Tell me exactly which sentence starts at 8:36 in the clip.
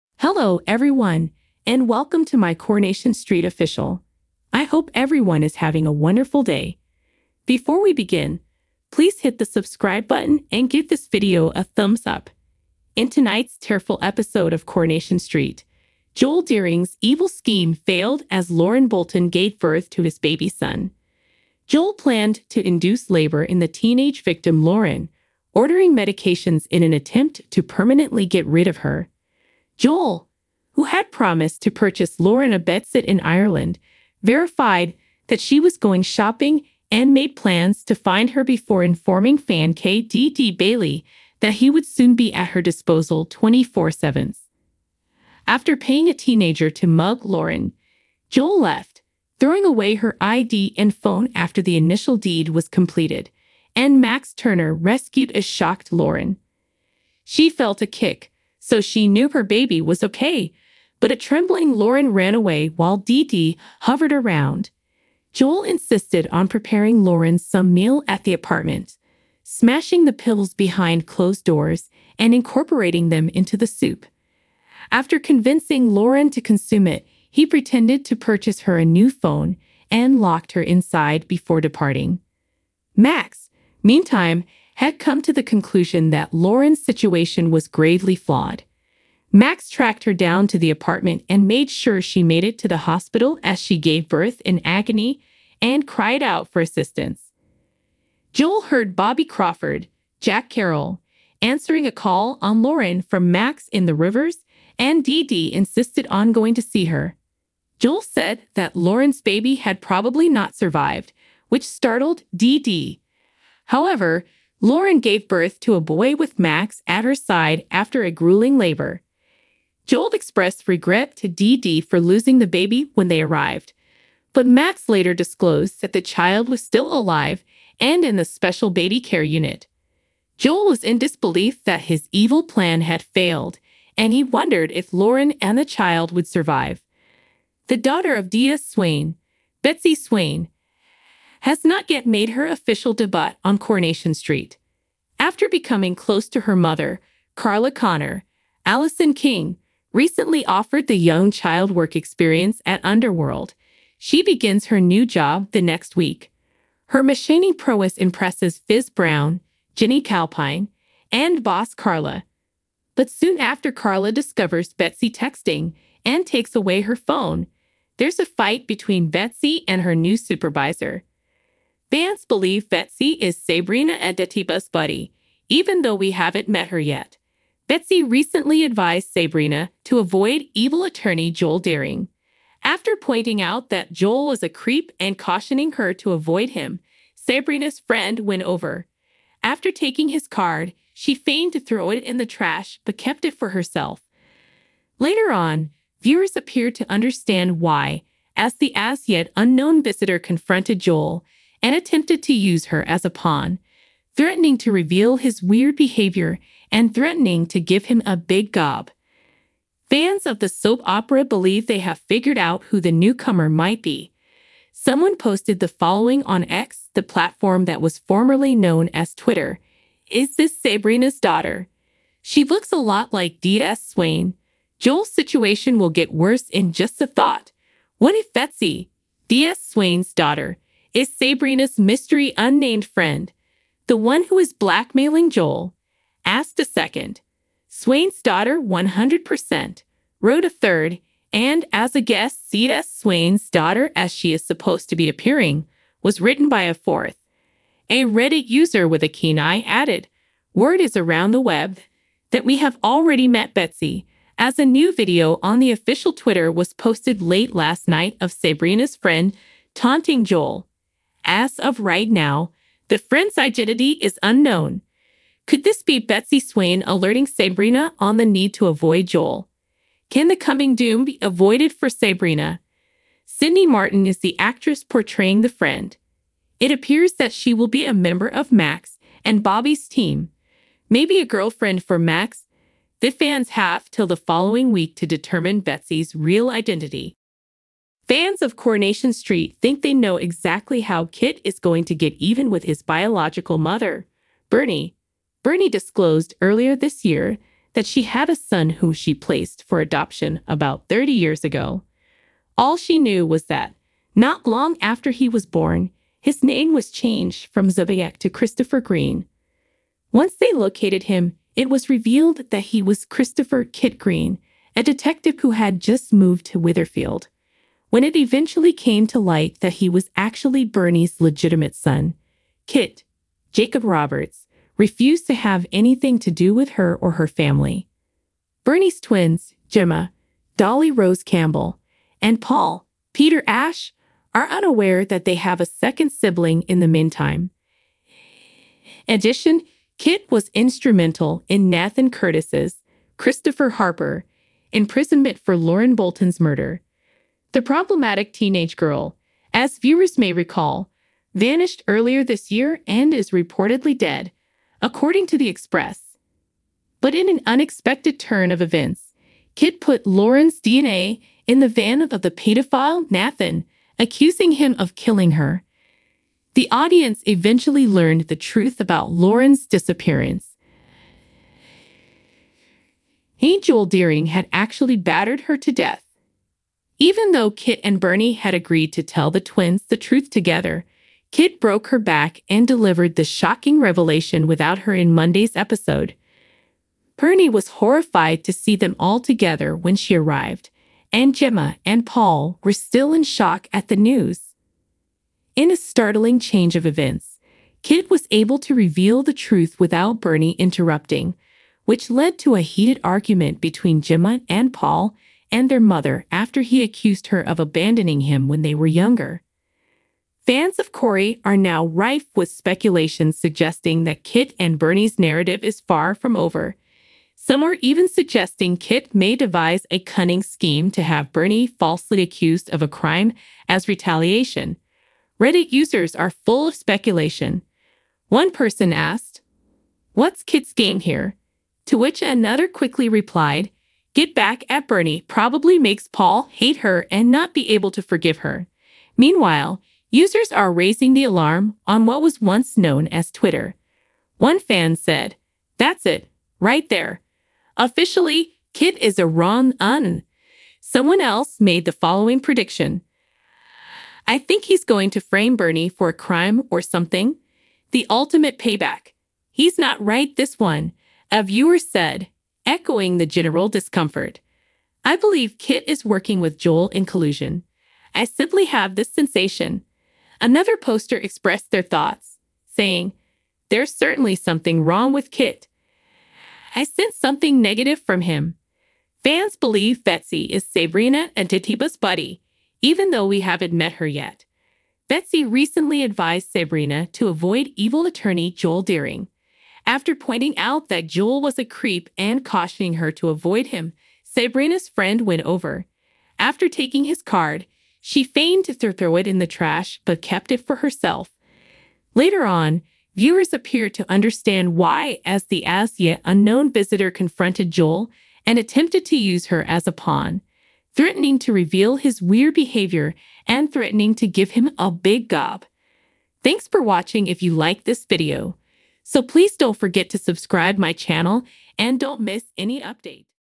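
Thanks for watching if you like this video.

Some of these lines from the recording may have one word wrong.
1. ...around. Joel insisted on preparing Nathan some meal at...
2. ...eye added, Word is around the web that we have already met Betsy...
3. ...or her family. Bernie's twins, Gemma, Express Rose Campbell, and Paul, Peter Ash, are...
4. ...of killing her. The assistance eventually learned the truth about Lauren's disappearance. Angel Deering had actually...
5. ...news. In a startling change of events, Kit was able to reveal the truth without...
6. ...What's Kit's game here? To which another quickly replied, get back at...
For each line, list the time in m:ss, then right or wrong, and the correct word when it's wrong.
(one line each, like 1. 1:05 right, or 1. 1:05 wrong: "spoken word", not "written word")
1. 1:04 wrong: "Lauren", not "Nathan"
2. 4:09 right
3. 5:26 wrong: "Dolly", not "Express"
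4. 6:04 wrong: "audience", not "assistance"
5. 6:33 right
6. 7:10 right.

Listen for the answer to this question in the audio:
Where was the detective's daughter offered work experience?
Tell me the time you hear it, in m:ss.
2:32.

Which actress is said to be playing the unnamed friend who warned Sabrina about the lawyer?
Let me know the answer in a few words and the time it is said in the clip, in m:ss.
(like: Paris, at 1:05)
Sydney Martin, at 4:33.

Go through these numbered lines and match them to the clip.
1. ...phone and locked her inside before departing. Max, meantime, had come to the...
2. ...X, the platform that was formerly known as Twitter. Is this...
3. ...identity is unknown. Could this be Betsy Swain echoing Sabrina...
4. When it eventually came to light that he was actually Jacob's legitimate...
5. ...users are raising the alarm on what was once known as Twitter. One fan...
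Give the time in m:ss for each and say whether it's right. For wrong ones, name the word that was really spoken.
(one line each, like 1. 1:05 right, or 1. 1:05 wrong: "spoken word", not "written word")
1. 1:19 right
2. 3:36 right
3. 4:23 wrong: "alerting", not "echoing"
4. 5:17 wrong: "Bernie", not "Jacob"
5. 7:20 right.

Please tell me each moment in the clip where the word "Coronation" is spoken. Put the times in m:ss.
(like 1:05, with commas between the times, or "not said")
0:02, 0:14, 2:23, 4:48.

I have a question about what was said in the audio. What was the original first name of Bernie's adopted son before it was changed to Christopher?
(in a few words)
Zodiac.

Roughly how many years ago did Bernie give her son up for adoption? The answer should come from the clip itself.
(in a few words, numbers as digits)
30.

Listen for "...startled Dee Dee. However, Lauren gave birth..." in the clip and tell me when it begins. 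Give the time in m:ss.
1:51.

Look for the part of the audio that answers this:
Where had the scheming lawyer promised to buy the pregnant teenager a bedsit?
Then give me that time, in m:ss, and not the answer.
0:33.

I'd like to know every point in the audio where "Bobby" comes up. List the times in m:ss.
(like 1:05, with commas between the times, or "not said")
1:38, 4:39.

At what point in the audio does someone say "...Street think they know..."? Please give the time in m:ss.
4:49.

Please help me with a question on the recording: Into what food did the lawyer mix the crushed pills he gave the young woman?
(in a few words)
Soup.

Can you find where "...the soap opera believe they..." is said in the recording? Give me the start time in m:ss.
3:30.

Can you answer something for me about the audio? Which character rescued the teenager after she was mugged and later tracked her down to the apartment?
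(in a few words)
Max Turner.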